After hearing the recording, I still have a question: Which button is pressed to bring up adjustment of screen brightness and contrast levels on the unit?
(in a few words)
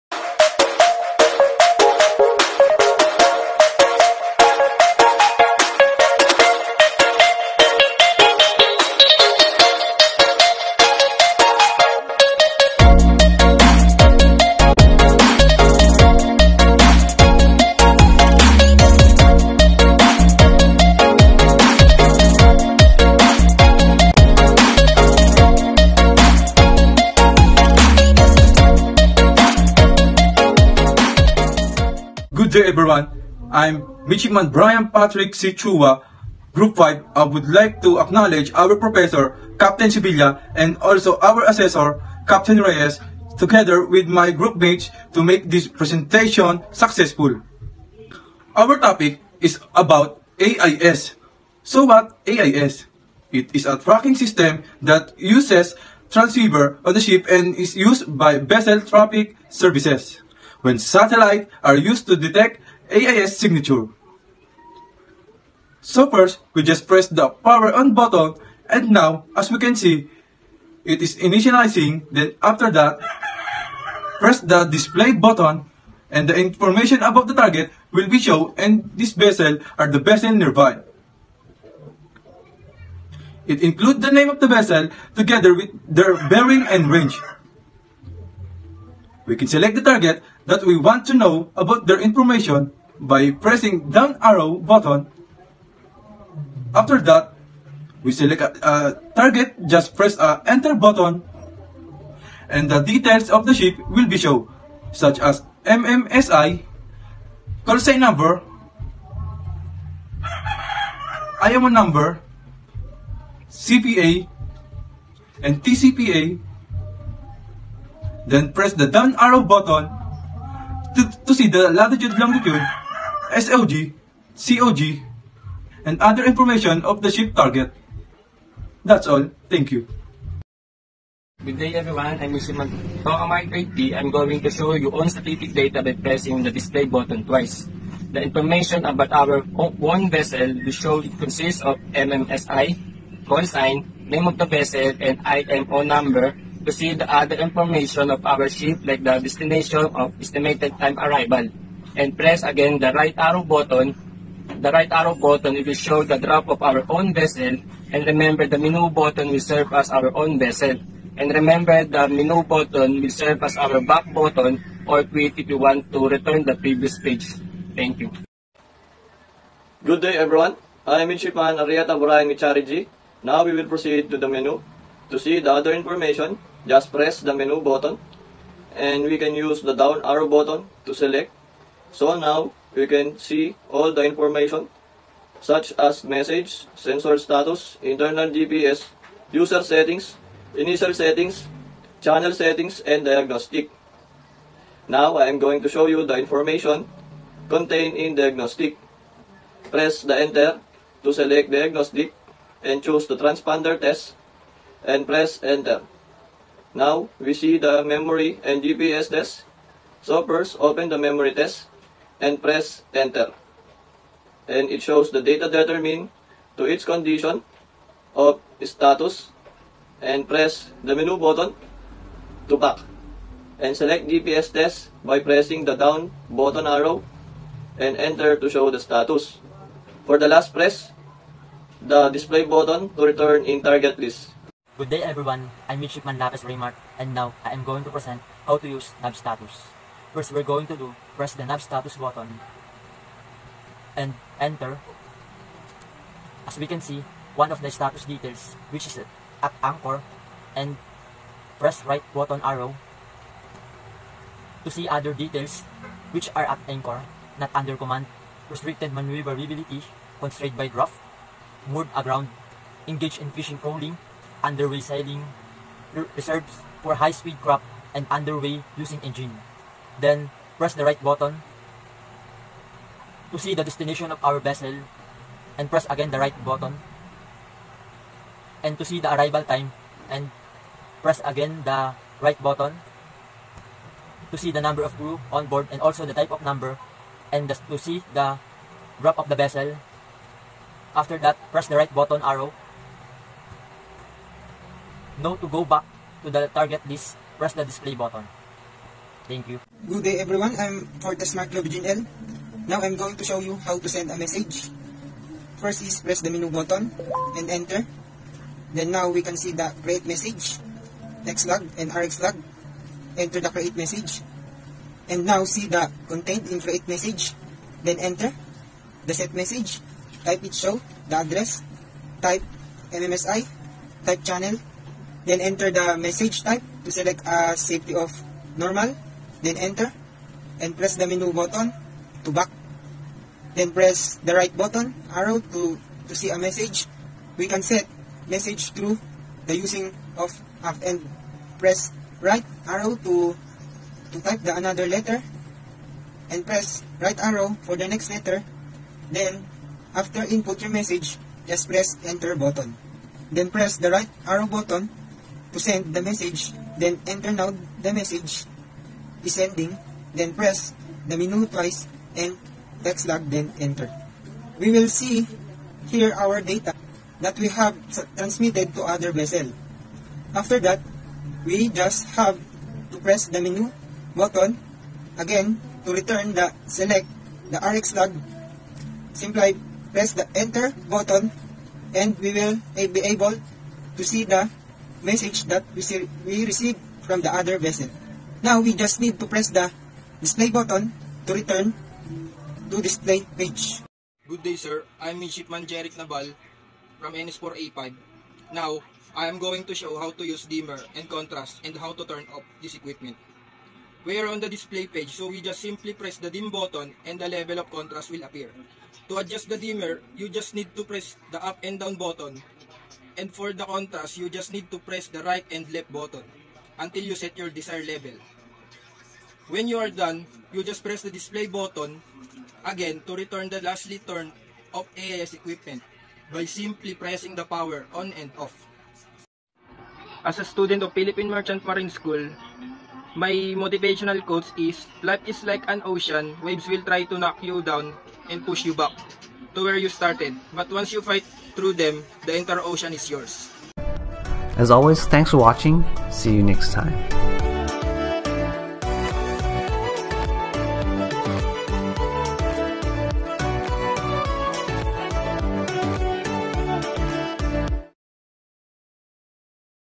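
Dim button.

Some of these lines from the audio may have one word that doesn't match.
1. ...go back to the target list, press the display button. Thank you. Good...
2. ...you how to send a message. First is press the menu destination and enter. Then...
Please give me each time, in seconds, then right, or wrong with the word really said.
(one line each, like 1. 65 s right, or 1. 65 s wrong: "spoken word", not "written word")
1. 295 s right
2. 303 s wrong: "button", not "destination".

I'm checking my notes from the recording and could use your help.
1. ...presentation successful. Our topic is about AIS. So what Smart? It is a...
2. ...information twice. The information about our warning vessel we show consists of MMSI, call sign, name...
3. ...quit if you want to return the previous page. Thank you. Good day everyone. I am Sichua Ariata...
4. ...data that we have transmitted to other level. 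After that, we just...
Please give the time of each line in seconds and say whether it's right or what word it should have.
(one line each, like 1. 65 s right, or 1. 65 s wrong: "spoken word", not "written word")
1. 45 s wrong: "AIS", not "Smart"
2. 136 s wrong: "button", not "information"
3. 165 s wrong: "Midshipman", not "Sichua"
4. 366 s wrong: "vessel", not "level".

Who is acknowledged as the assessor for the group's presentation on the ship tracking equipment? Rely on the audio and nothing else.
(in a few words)
Captain Reyes.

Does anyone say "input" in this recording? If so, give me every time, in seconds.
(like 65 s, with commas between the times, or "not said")
350 s.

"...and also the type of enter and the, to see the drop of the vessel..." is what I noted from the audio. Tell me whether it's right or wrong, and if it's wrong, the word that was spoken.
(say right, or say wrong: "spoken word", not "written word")
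wrong: "number", not "enter".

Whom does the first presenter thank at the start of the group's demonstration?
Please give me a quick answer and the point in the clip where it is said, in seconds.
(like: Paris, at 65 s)
Captain Sevilla, at 39 s.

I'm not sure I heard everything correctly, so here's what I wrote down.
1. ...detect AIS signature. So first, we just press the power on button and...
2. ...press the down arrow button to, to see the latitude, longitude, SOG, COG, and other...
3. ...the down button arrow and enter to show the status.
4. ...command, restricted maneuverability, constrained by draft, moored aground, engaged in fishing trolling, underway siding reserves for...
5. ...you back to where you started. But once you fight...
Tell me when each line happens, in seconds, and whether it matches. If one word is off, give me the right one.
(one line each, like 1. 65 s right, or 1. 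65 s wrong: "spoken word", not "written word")
1. 62 s right
2. 118 s right
3. 225 s right
4. 257 s right
5. 438 s right.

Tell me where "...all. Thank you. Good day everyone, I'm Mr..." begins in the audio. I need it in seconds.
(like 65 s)
129 s.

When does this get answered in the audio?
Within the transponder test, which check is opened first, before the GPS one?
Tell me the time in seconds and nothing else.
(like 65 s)
210 s.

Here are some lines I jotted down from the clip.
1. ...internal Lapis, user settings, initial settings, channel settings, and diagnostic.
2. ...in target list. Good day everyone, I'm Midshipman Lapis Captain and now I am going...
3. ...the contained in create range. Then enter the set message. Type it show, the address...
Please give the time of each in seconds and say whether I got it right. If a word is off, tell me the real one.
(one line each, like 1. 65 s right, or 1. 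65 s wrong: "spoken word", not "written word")
1. 187 s wrong: "GPS", not "Lapis"
2. 233 s wrong: "Remark", not "Captain"
3. 315 s wrong: "message", not "range".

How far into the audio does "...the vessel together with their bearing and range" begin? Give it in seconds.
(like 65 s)
84 s.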